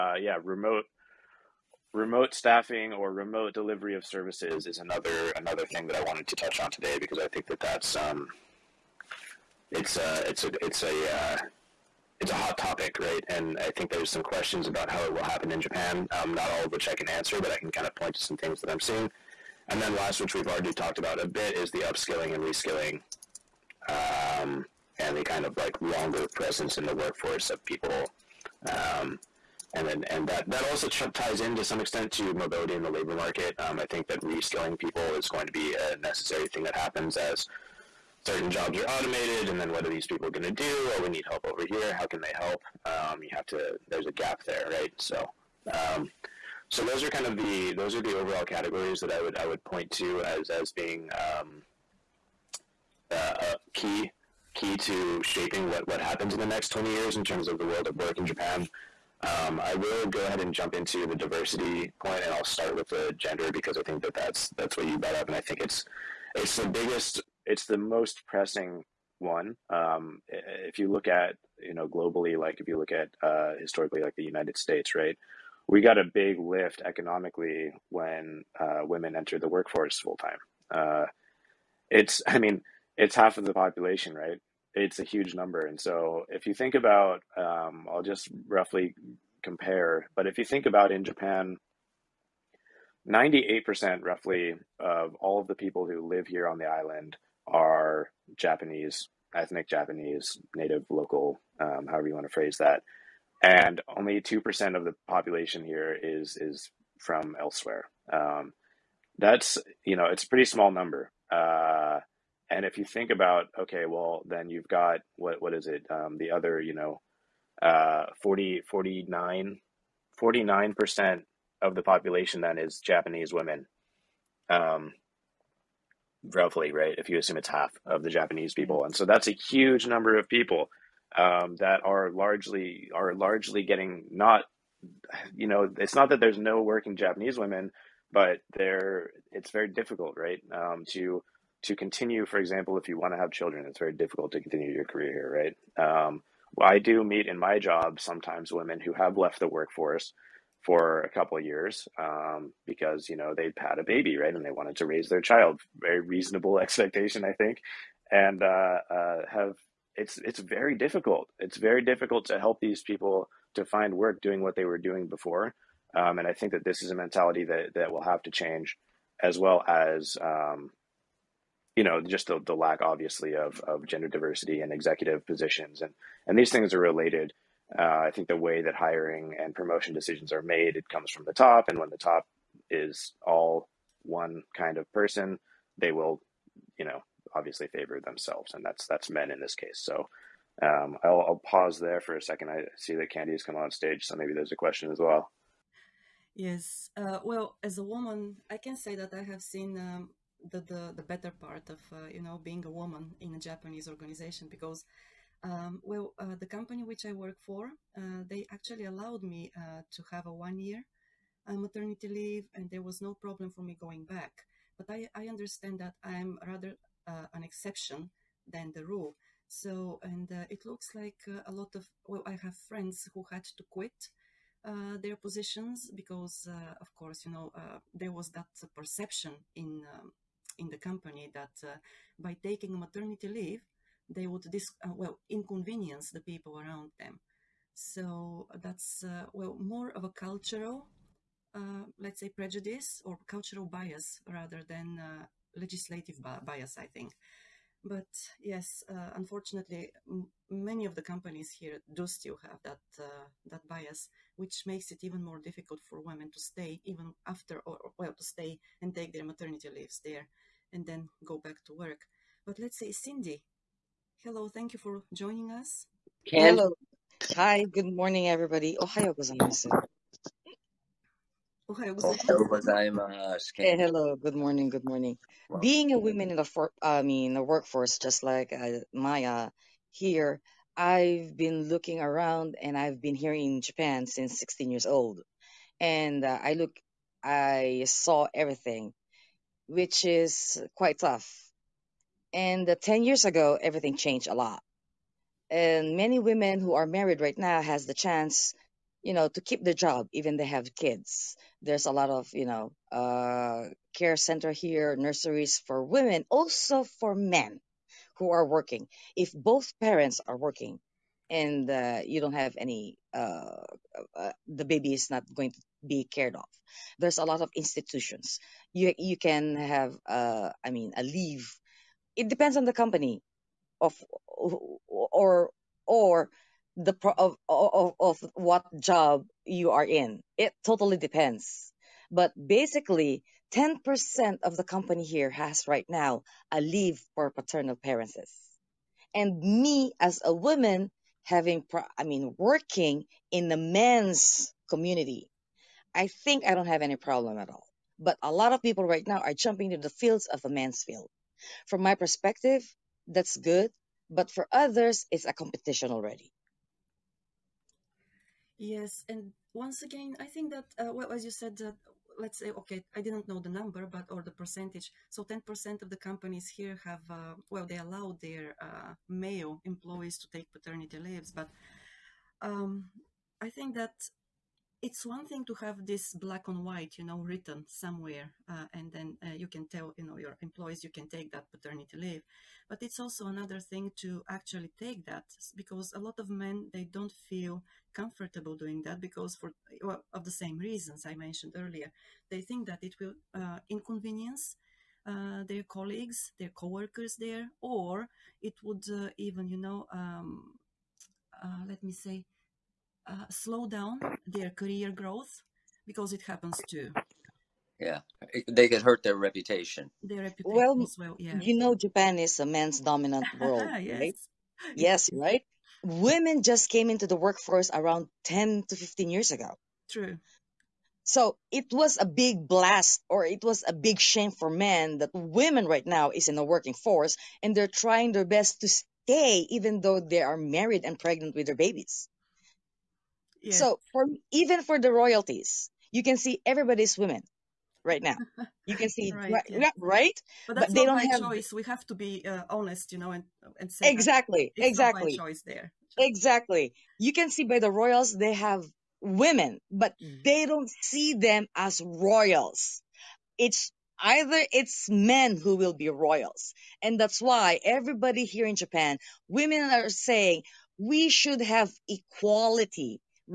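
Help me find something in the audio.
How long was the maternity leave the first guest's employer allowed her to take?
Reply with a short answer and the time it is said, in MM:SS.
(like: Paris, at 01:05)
One year, at 03:30.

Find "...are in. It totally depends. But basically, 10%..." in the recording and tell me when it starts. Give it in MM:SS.
05:29.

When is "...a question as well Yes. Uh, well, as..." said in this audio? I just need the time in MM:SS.
03:14.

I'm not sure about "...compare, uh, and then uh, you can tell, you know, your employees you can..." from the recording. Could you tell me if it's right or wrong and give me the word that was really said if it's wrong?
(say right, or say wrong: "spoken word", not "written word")
wrong: "somewhere", not "compare".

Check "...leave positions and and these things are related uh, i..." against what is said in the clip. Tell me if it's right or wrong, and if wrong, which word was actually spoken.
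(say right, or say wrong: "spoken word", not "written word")
wrong: "executive", not "leave".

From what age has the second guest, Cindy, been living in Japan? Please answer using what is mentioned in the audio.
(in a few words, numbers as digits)
16.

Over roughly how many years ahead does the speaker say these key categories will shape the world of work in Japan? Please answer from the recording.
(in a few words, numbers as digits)
20.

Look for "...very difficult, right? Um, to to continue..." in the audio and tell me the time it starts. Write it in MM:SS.
02:19.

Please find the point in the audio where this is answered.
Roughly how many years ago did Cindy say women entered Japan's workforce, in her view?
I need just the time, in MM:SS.
06:58.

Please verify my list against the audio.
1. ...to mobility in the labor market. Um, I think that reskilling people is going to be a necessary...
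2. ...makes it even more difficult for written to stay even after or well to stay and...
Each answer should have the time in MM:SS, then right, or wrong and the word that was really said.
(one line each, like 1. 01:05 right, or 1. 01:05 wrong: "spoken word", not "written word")
1. 00:32 right
2. 04:14 wrong: "women", not "written".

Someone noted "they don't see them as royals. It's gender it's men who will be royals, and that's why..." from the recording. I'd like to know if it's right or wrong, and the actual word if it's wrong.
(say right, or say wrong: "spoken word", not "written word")
wrong: "either", not "gender".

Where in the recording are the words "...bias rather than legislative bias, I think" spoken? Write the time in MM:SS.
04:03.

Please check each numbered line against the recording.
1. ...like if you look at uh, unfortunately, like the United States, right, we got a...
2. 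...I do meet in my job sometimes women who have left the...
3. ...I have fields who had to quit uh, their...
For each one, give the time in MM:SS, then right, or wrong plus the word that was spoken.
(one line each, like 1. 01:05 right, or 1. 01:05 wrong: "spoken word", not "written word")
1. 01:12 wrong: "historically", not "unfortunately"
2. 02:26 right
3. 03:42 wrong: "friends", not "fields".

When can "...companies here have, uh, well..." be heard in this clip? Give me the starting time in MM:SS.
06:05.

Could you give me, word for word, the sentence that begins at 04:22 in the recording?
But let's say Cindy, hello, thank you for joining us.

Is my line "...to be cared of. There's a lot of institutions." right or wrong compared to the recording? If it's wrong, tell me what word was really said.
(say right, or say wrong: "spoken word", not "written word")
right.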